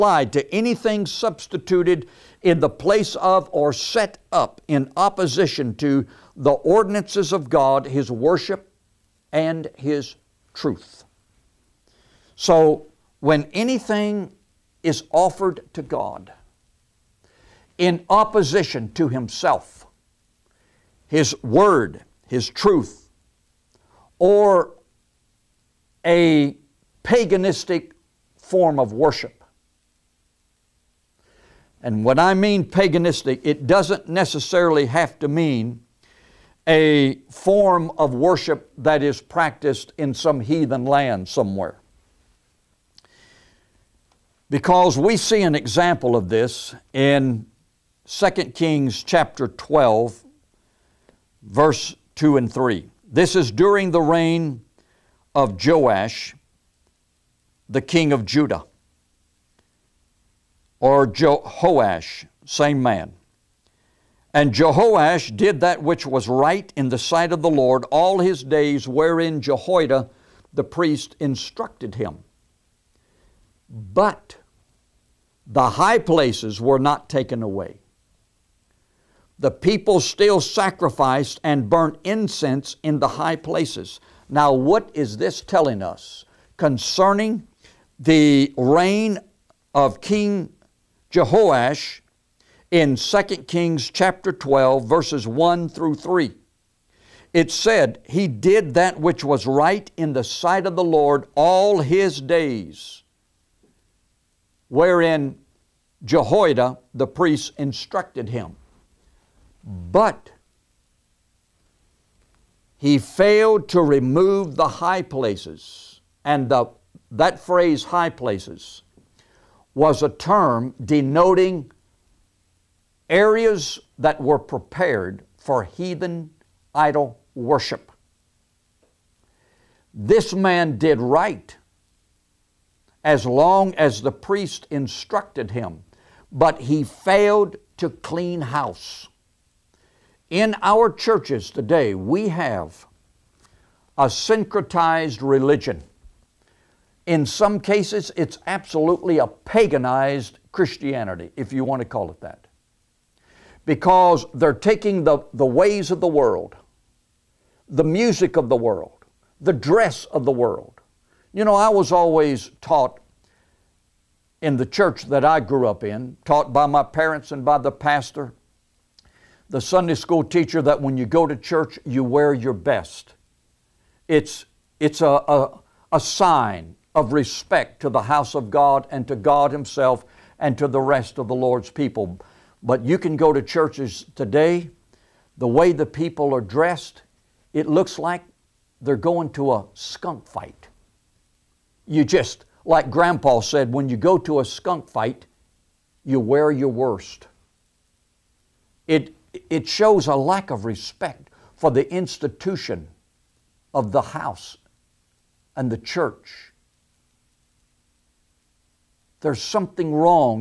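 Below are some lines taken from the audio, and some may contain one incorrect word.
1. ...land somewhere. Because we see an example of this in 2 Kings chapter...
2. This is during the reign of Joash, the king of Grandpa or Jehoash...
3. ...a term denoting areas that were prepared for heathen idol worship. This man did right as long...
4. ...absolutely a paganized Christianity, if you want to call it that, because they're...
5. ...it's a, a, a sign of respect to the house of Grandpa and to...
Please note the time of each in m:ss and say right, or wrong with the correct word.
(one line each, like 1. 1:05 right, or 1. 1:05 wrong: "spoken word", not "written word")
1. 0:40 right
2. 0:53 wrong: "Judah", not "Grandpa"
3. 2:00 right
4. 2:28 right
5. 2:54 wrong: "God", not "Grandpa".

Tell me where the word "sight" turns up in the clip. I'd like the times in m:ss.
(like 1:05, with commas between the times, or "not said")
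1:06, 1:40.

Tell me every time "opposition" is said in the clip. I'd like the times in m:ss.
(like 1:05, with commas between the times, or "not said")
0:04, 0:18.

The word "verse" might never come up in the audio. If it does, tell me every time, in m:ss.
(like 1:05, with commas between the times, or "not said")
0:51, 1:34.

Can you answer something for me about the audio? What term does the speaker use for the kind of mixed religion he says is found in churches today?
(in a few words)
syncretized religion.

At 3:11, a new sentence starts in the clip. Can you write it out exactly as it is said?
You just, like Grandpa said, when you go to a skunk fight, you wear your worst.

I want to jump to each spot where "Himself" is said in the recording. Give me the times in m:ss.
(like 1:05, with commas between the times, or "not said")
0:19, 2:59.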